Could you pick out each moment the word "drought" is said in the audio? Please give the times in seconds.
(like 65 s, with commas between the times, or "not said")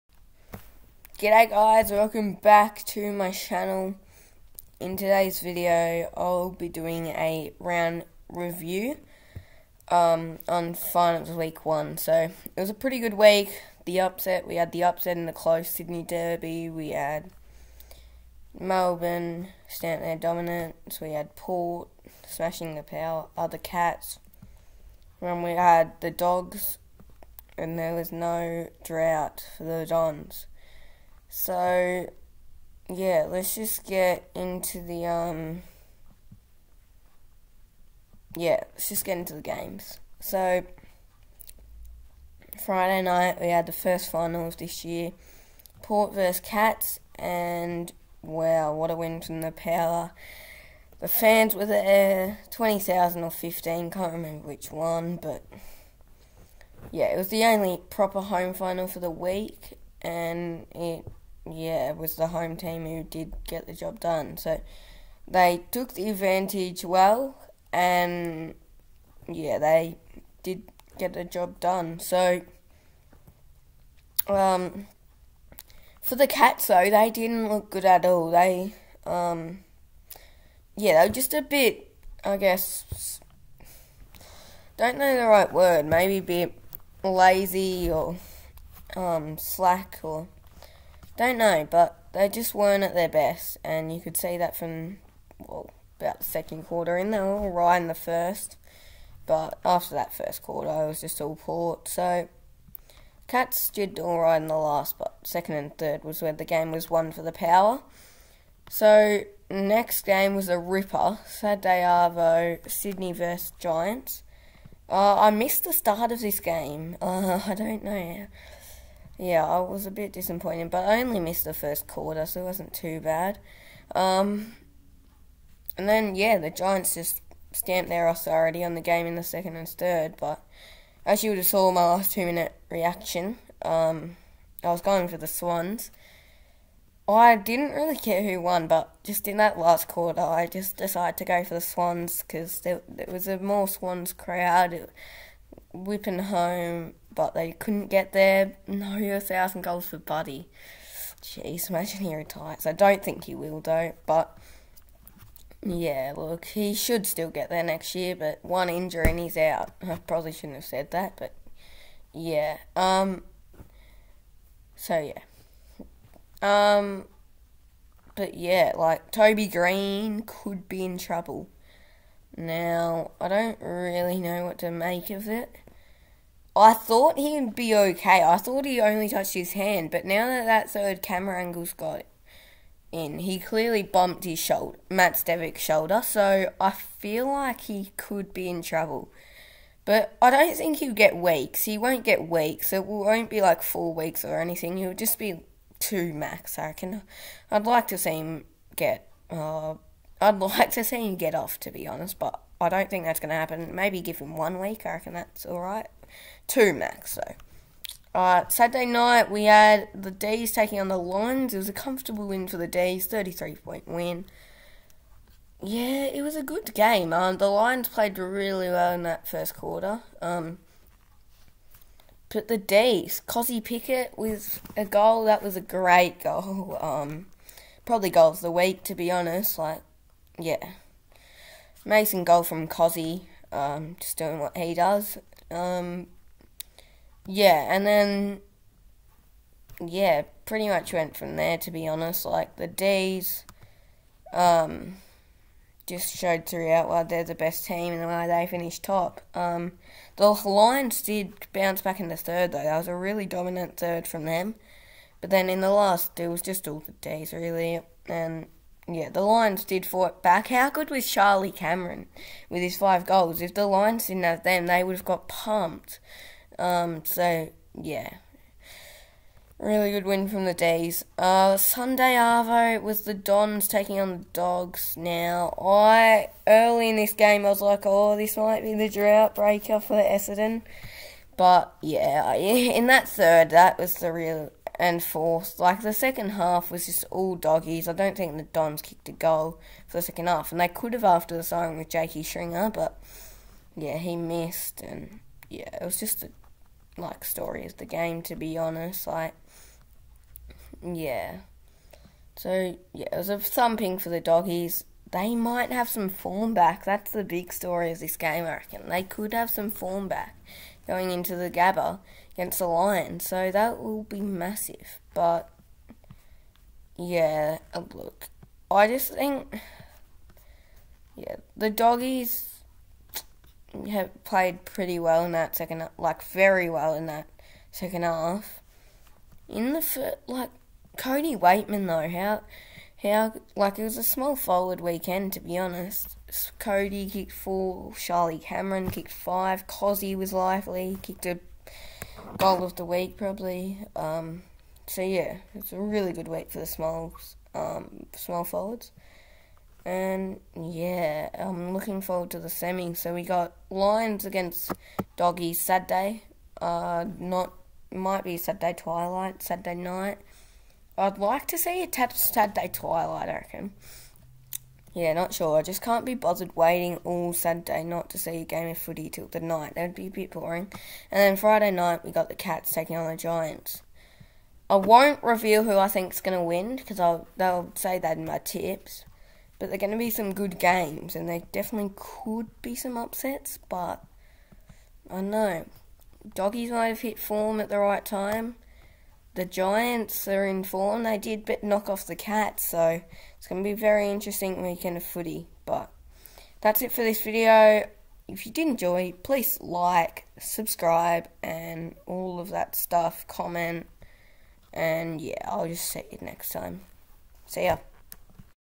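28 s, 278 s.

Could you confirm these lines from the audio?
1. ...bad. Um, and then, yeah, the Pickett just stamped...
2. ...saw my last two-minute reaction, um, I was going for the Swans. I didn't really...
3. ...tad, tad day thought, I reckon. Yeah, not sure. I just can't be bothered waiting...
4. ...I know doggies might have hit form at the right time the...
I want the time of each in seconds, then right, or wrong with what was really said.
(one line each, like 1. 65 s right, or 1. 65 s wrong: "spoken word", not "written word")
1. 123 s wrong: "Giants", not "Pickett"
2. 131 s right
3. 361 s wrong: "twilight", not "thought"
4. 385 s right.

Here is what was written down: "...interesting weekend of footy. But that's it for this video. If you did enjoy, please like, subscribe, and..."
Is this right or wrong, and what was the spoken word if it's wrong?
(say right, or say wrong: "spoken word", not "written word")
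right.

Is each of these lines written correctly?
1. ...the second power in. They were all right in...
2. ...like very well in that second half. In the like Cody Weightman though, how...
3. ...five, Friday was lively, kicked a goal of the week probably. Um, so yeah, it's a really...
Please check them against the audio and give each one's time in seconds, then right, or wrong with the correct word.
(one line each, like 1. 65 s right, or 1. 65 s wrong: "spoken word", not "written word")
1. 96 s wrong: "quarter", not "power"
2. 325 s right
3. 339 s wrong: "Cozzy", not "Friday".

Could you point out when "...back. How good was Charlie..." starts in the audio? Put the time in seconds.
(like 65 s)
260 s.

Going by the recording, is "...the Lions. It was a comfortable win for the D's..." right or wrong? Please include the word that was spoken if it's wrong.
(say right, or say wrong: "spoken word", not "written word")
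right.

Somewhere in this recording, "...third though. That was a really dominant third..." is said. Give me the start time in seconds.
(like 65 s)
252 s.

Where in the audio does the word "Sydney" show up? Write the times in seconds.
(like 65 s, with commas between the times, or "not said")
15 s, 112 s.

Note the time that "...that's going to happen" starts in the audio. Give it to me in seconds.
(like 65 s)
203 s.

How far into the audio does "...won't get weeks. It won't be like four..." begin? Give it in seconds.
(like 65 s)
191 s.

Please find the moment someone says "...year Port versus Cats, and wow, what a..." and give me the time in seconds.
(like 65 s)
44 s.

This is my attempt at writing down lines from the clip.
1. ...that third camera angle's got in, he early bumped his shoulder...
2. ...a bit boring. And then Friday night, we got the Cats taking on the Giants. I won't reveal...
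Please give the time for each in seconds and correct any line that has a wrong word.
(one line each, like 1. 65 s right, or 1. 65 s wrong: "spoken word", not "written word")
1. 180 s wrong: "clearly", not "early"
2. 370 s right.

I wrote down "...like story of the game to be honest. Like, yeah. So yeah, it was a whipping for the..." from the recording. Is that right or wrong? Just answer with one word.
wrong.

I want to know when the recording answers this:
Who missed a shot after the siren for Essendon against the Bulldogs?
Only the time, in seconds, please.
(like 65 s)
291 s.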